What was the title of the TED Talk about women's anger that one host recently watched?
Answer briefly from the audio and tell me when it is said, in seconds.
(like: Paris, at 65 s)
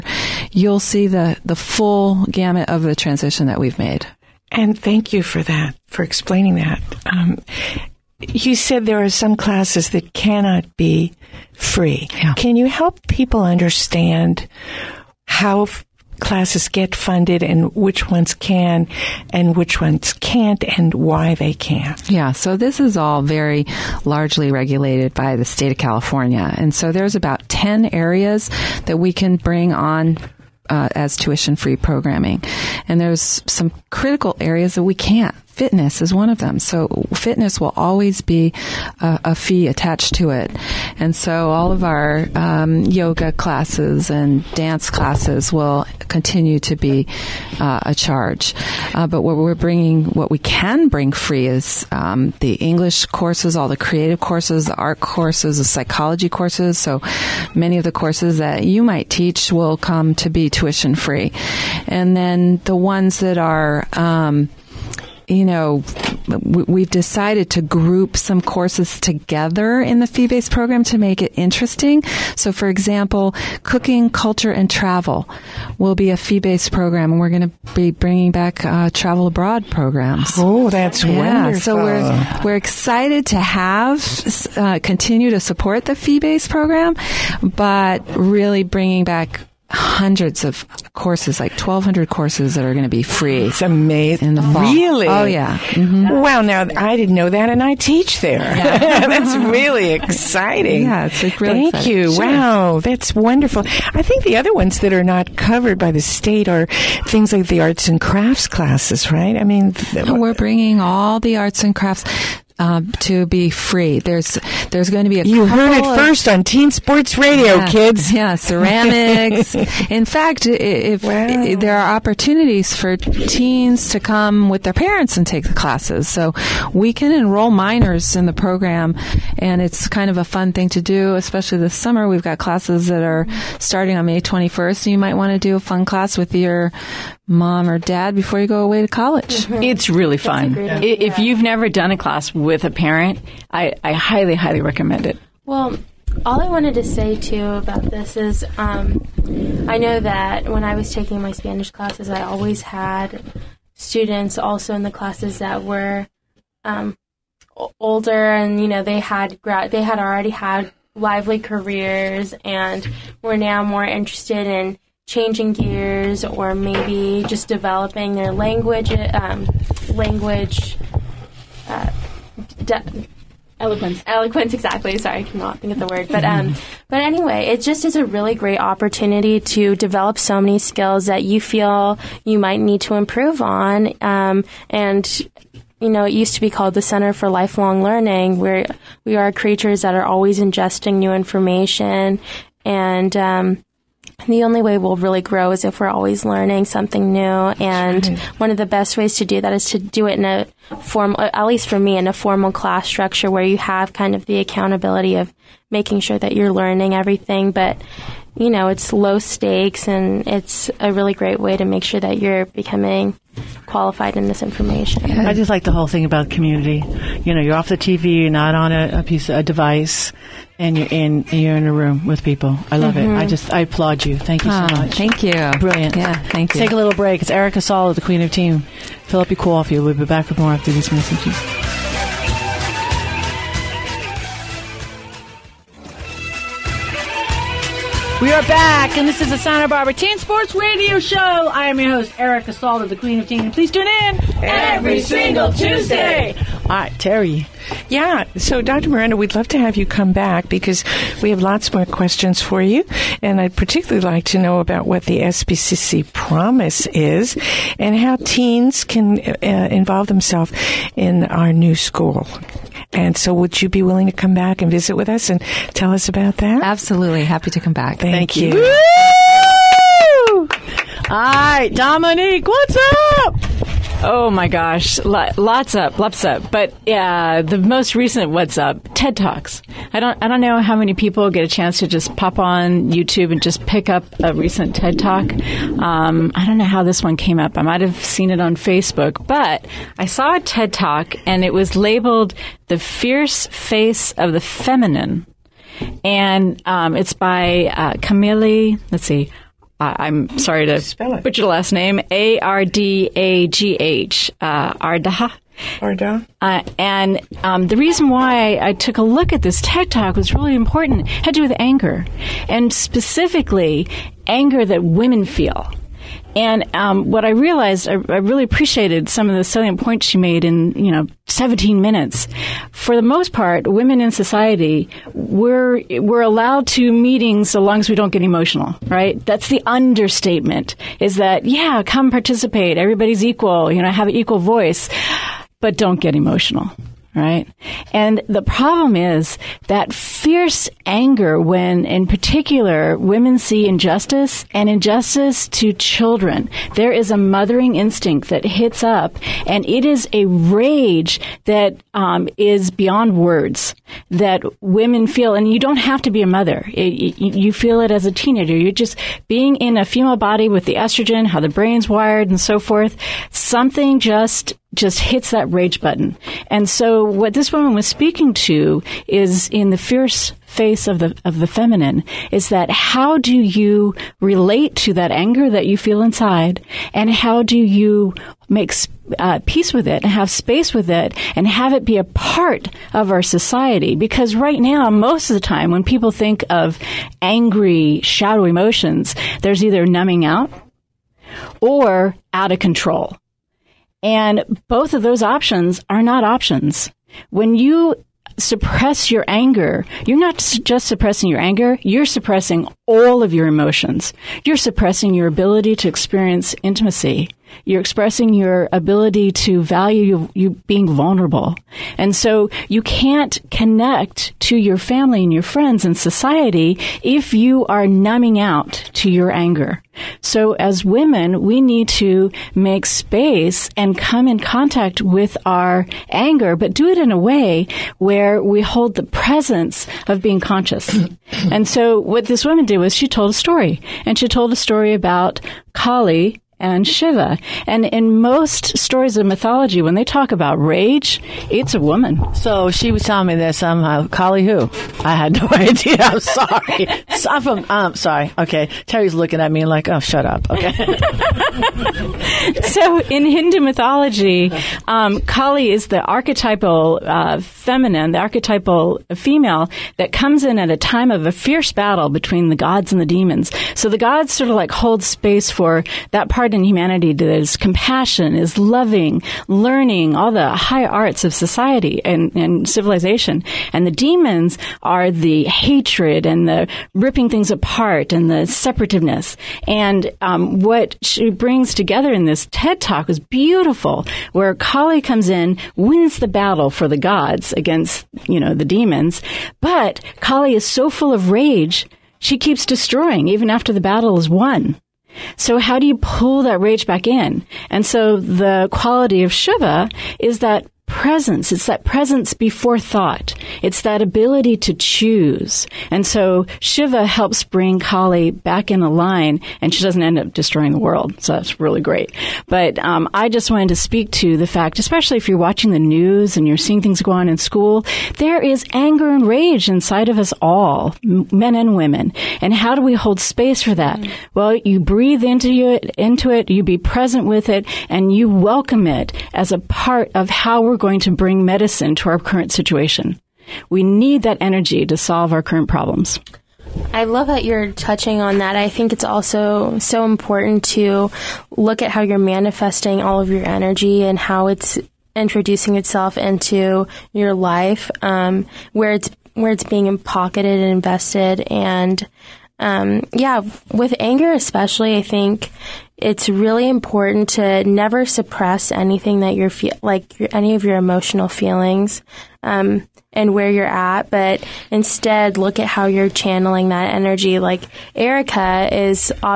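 The Fierce Face of the Feminine, at 292 s.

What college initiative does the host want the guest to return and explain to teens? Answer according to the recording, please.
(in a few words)
SBCC promise.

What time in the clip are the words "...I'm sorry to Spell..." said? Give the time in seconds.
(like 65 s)
299 s.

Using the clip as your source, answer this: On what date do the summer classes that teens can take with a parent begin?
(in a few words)
May 21st.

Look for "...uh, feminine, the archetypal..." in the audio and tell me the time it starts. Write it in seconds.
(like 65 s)
457 s.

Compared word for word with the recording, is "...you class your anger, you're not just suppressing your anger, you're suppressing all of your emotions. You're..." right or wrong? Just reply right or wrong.
wrong.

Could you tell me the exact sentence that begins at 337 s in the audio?
And the problem is that fierce anger when, in particular, women see injustice and injustice to children.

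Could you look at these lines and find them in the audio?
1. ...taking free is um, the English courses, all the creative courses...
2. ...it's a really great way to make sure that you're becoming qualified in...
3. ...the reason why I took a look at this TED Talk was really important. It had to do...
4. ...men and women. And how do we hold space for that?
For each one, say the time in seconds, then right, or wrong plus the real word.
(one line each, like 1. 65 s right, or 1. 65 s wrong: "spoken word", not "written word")
1. 50 s wrong: "bring", not "taking"
2. 210 s right
3. 307 s right
4. 521 s right.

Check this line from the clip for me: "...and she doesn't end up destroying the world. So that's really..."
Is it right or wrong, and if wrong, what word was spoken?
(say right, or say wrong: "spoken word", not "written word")
right.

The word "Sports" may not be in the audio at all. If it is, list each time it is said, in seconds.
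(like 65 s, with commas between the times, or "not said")
116 s, 240 s.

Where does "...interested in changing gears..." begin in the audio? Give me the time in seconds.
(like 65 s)
163 s.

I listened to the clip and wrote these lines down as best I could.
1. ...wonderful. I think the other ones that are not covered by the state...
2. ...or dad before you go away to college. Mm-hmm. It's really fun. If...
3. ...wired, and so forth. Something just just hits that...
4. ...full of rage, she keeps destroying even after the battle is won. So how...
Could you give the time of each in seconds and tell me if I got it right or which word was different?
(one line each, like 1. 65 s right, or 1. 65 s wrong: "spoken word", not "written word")
1. 103 s right
2. 137 s right
3. 361 s right
4. 490 s right.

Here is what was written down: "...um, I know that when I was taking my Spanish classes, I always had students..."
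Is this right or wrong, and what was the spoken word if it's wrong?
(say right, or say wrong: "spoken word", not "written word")
right.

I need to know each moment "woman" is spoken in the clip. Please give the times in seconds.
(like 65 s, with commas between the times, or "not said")
367 s, 432 s, 441 s.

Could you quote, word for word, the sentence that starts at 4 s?
And thank you for that, for explaining that.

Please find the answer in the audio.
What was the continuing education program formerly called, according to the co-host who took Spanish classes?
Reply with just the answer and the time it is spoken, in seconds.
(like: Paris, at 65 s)
Center for Lifelong Learning, at 186 s.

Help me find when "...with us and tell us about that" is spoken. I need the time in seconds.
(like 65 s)
264 s.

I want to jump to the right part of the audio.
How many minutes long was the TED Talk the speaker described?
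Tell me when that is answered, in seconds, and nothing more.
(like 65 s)
321 s.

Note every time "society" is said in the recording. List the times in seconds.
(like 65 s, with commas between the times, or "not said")
324 s, 383 s, 415 s, 471 s.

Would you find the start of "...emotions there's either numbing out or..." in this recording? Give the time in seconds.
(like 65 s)
388 s.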